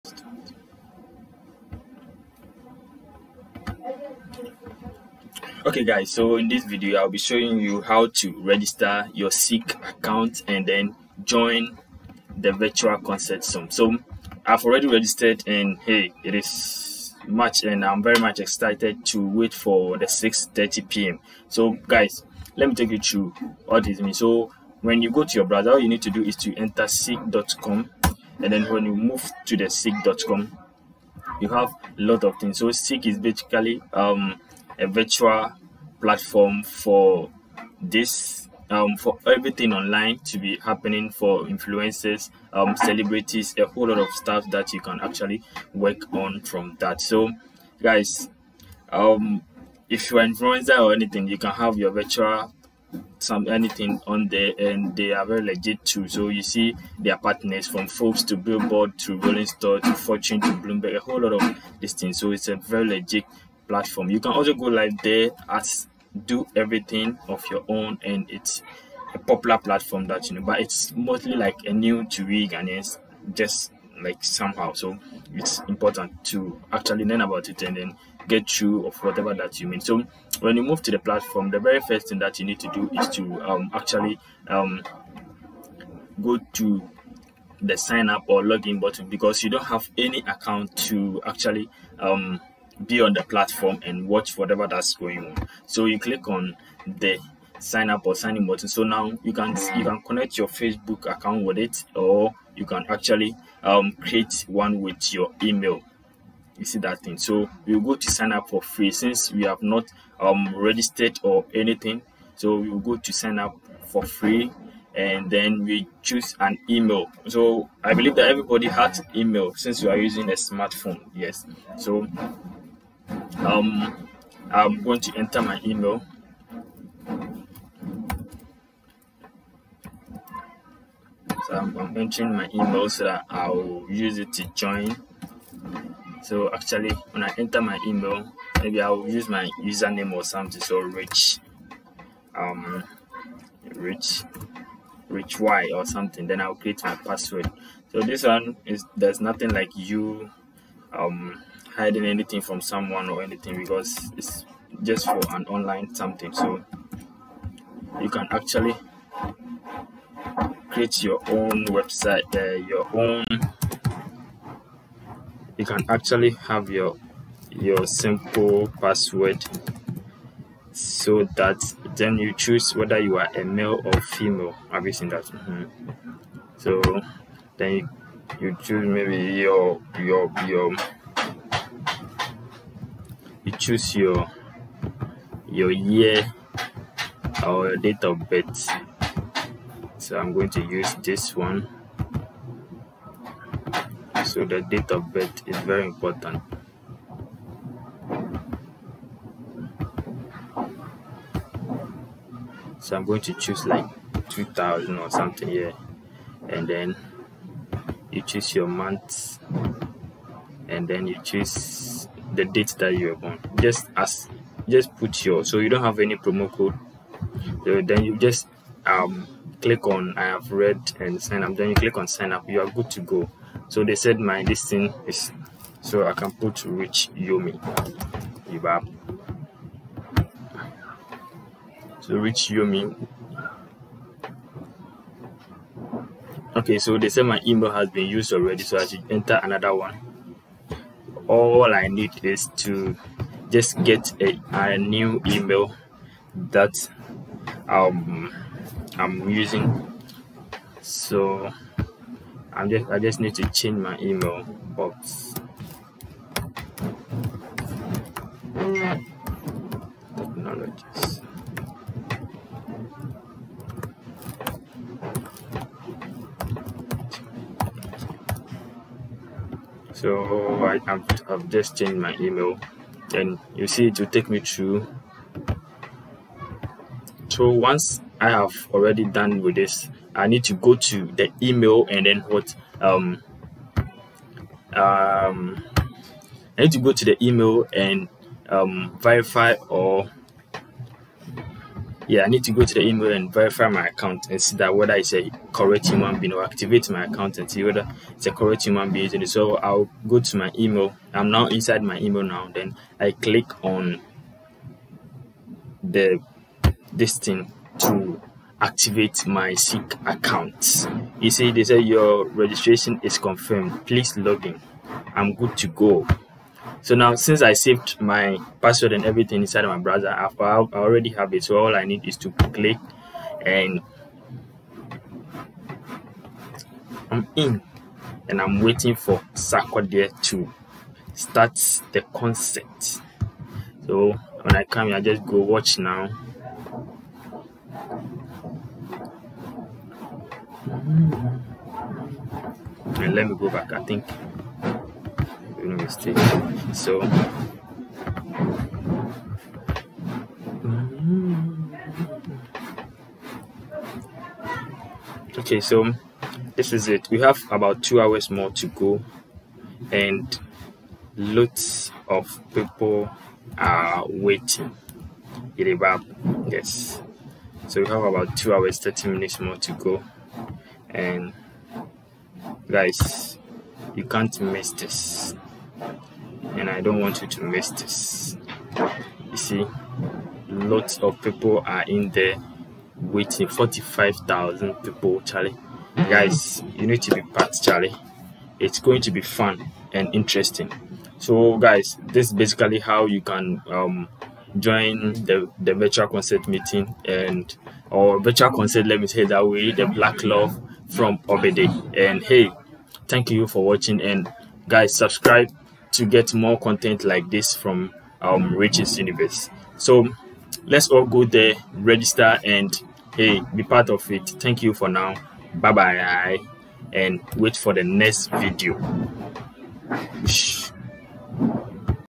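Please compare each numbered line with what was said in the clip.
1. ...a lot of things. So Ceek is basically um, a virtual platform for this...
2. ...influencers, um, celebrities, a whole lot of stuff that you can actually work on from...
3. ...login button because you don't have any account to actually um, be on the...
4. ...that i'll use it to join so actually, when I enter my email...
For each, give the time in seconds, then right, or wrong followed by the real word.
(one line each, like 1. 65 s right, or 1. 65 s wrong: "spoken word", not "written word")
1. 31 s right
2. 41 s right
3. 88 s right
4. 133 s right.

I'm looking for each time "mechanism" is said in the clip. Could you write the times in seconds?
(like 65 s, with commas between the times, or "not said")
not said.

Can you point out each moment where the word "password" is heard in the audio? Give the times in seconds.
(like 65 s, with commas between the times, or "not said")
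146 s, 168 s, 318 s.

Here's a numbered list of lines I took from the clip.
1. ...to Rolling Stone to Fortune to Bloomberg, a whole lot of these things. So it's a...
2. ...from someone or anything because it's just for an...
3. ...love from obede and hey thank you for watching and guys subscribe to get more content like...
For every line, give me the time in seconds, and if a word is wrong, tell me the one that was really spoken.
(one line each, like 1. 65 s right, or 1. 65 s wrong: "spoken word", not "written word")
1. 58 s right
2. 152 s right
3. 400 s right.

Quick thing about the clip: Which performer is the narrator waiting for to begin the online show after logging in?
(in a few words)
Sarkodie.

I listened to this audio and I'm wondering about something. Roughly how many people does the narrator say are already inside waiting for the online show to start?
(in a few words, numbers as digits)
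45,000.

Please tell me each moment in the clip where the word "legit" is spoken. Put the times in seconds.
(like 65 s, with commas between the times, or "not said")
55 s, 62 s.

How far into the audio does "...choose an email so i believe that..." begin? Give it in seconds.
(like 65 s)
116 s.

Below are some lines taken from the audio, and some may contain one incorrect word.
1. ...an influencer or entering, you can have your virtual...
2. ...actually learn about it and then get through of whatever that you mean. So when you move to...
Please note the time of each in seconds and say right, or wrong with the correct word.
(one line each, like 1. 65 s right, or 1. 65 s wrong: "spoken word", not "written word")
1. 50 s wrong: "anything", not "entering"
2. 76 s right.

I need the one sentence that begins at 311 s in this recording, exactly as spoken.
You see, they say your registration is confirmed.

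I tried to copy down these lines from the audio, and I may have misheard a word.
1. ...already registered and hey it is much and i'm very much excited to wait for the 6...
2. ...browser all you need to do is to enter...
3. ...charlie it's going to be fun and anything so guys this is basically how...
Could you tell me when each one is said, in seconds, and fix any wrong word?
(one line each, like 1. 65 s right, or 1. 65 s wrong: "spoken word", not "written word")
1. 14 s right
2. 25 s right
3. 387 s wrong: "interesting", not "anything".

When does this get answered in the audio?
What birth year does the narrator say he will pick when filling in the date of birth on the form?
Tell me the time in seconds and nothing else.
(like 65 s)
204 s.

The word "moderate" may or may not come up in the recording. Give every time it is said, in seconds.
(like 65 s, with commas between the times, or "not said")
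not said.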